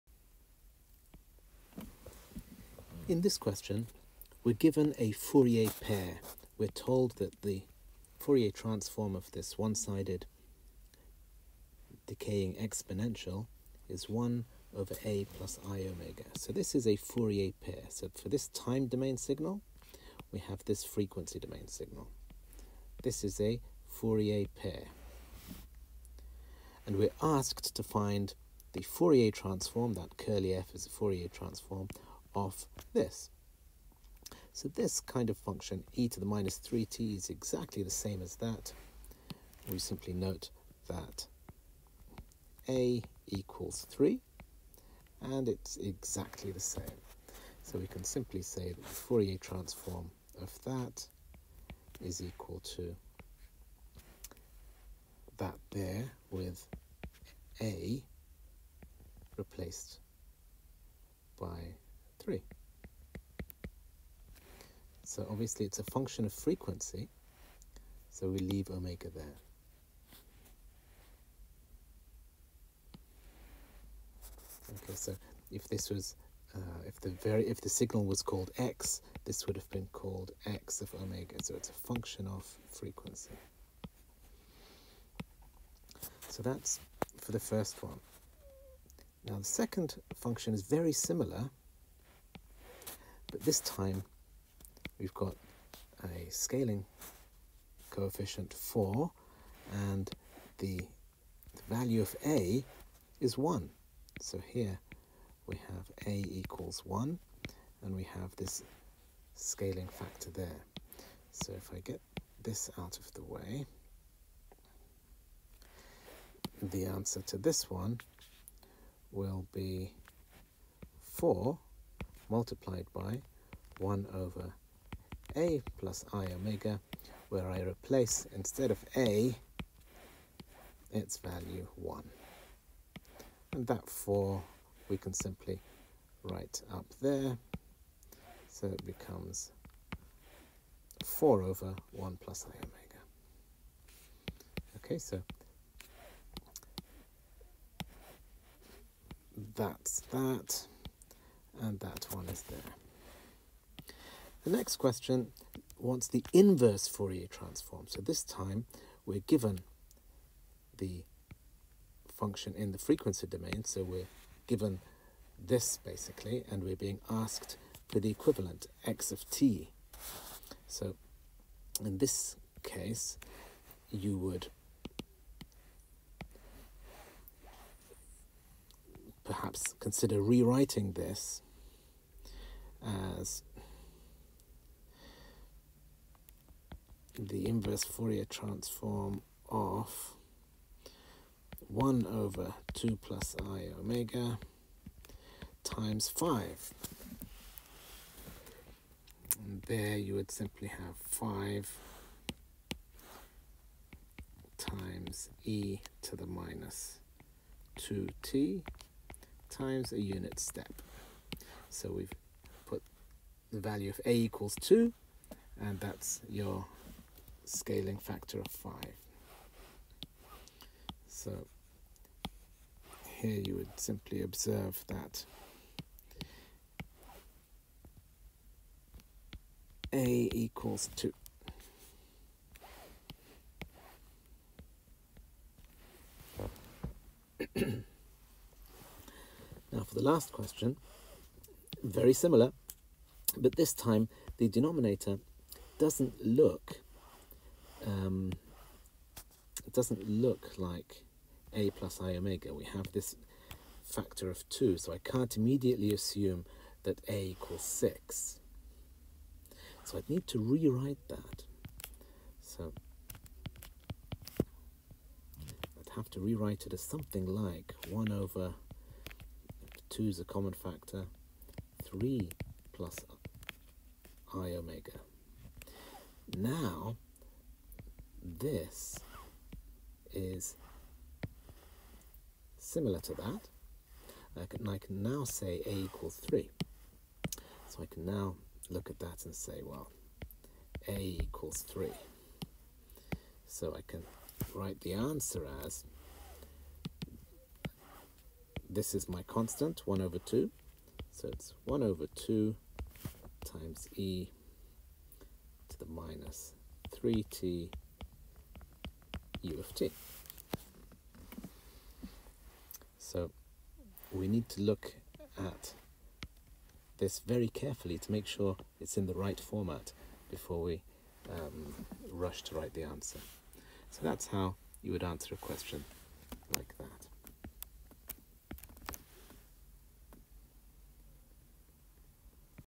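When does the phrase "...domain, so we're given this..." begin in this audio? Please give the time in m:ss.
2:43.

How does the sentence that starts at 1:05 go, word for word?
So obviously it's a function of frequency, so we leave omega there.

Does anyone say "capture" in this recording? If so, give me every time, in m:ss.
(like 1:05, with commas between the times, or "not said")
not said.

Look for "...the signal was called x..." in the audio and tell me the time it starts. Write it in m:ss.
1:17.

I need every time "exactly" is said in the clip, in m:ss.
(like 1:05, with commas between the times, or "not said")
0:37, 0:45.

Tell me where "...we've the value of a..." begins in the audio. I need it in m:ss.
3:31.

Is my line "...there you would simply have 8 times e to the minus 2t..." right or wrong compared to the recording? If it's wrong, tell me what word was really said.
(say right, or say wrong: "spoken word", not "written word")
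wrong: "5", not "8".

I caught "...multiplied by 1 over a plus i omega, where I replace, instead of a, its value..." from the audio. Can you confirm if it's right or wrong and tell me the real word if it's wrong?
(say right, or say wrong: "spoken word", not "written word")
right.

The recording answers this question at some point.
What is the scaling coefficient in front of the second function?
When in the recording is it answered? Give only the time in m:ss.
1:36.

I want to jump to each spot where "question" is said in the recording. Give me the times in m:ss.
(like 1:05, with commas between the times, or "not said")
0:03, 2:34, 4:00, 5:25.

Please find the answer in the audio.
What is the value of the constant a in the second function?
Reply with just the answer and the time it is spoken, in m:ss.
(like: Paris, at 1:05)
1, at 1:41.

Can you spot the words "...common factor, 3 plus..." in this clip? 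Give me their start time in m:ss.
4:30.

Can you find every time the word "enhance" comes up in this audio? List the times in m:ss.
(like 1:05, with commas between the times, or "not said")
not said.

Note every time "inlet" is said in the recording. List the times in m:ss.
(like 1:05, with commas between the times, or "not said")
not said.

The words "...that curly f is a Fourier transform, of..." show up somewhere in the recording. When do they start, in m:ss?
0:29.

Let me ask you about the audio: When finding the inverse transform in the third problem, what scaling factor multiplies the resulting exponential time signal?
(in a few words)
5.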